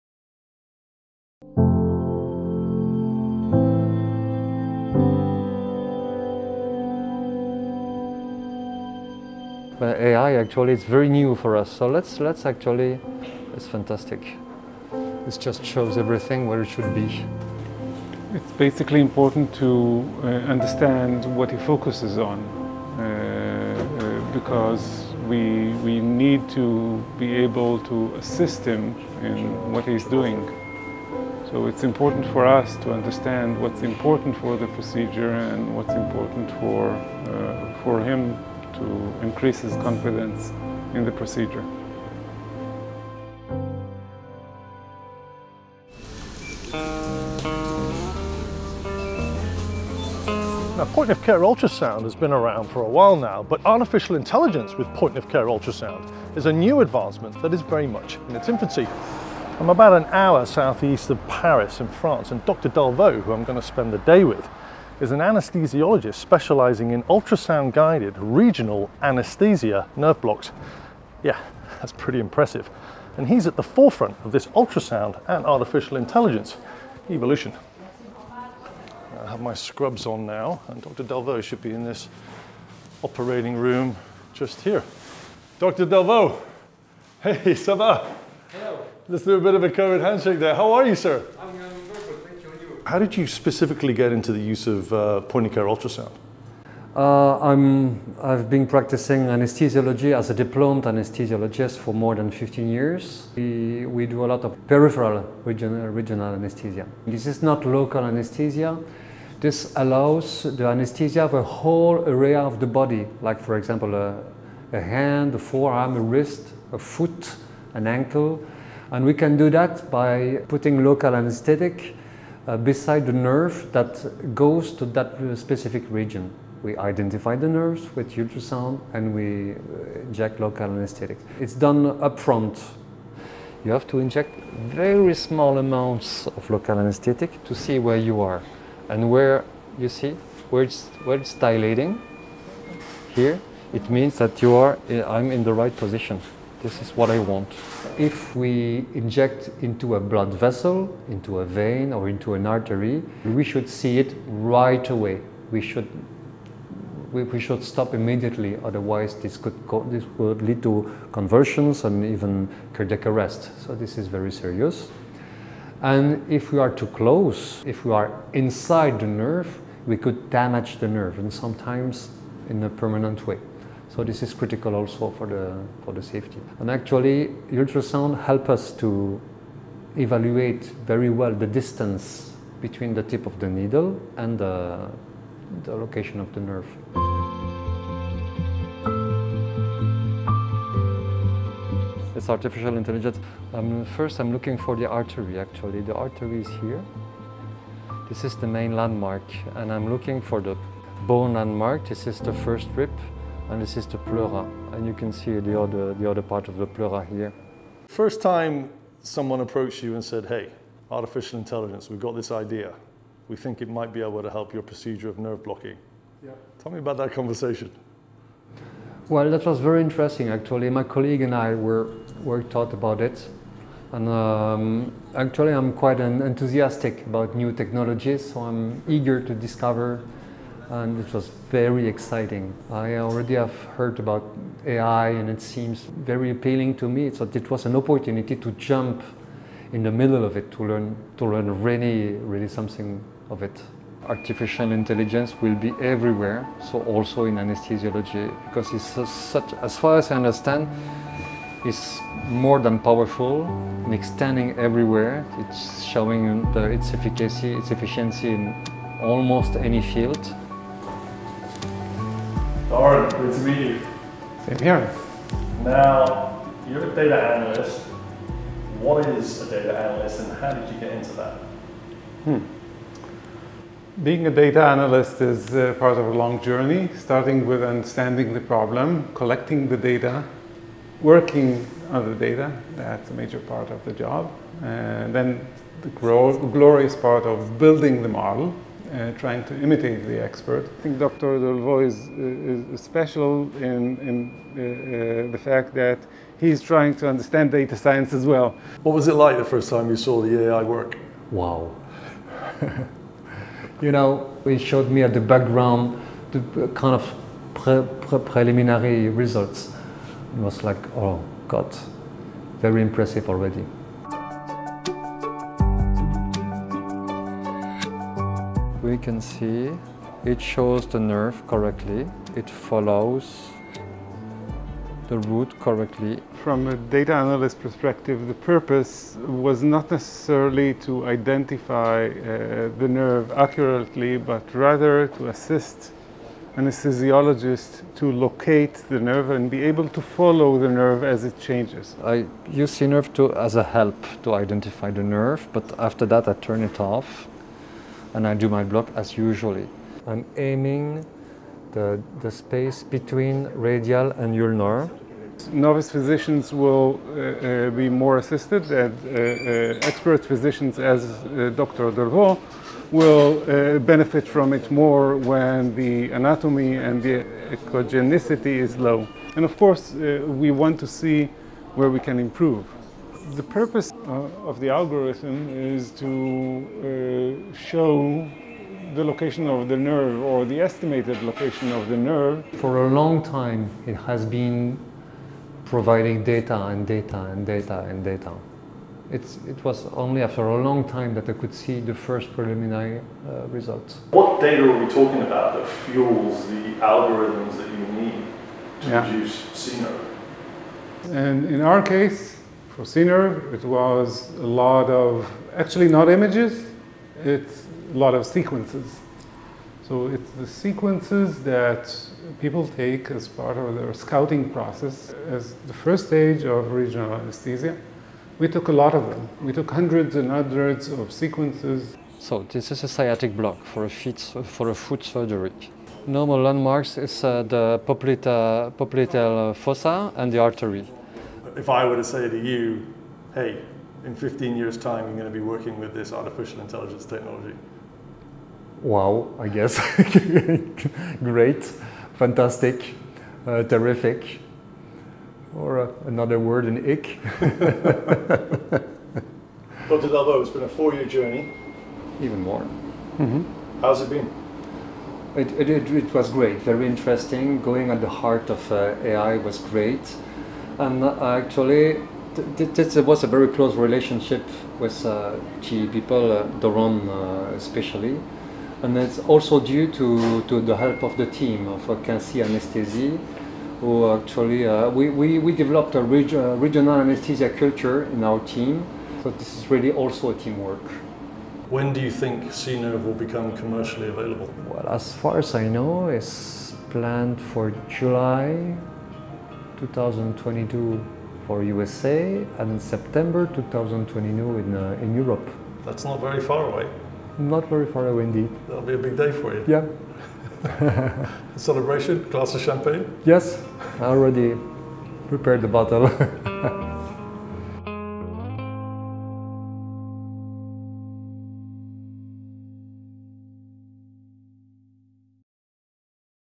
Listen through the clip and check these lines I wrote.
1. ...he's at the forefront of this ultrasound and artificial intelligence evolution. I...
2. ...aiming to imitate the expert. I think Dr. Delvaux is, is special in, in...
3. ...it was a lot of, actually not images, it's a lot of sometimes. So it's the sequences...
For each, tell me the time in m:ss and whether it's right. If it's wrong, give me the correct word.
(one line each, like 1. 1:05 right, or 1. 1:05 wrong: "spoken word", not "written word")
1. 1:13 right
2. 4:49 wrong: "trying", not "aiming"
3. 6:42 wrong: "sequences", not "sometimes".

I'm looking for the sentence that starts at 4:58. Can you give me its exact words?
What was it like the first time you saw the AI work?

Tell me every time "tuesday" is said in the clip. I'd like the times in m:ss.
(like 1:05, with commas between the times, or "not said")
not said.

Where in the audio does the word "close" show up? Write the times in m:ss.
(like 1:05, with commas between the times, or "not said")
2:46, 7:43.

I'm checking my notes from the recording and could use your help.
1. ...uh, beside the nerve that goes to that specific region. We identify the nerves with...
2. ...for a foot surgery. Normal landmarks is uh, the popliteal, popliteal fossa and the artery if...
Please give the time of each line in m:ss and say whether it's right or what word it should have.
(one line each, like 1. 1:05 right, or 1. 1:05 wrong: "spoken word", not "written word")
1. 2:02 right
2. 7:04 right.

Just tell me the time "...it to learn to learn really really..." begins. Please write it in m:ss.
4:00.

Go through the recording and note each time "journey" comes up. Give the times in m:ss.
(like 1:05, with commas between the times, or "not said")
4:36, 7:31.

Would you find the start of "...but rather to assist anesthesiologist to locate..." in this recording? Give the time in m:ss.
5:34.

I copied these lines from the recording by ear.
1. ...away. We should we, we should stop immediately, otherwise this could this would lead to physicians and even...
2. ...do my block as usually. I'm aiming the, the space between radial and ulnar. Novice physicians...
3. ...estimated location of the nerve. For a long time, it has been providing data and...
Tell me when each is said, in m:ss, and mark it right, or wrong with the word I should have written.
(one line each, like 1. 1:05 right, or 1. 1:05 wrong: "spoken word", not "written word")
1. 2:34 wrong: "convulsions", not "physicians"
2. 5:48 right
3. 6:20 right.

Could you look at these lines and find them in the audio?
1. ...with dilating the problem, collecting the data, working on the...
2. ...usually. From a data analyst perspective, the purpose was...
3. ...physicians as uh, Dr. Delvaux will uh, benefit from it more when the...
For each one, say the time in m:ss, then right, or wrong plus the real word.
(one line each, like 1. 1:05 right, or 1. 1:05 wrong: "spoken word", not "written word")
1. 4:37 wrong: "understanding", not "dilating"
2. 5:25 wrong: "correctly", not "usually"
3. 6:00 right.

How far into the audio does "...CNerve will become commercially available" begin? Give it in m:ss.
8:02.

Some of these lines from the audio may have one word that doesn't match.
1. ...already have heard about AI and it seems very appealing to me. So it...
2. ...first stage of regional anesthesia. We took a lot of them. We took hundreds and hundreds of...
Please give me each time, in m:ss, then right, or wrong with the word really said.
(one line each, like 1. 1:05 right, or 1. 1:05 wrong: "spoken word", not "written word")
1. 3:52 right
2. 6:55 right.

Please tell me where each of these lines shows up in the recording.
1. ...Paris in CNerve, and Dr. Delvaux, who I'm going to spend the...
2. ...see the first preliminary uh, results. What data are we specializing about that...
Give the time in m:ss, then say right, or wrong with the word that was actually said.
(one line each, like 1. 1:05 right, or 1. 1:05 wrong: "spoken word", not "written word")
1. 1:01 wrong: "France", not "CNerve"
2. 6:31 wrong: "talking", not "specializing".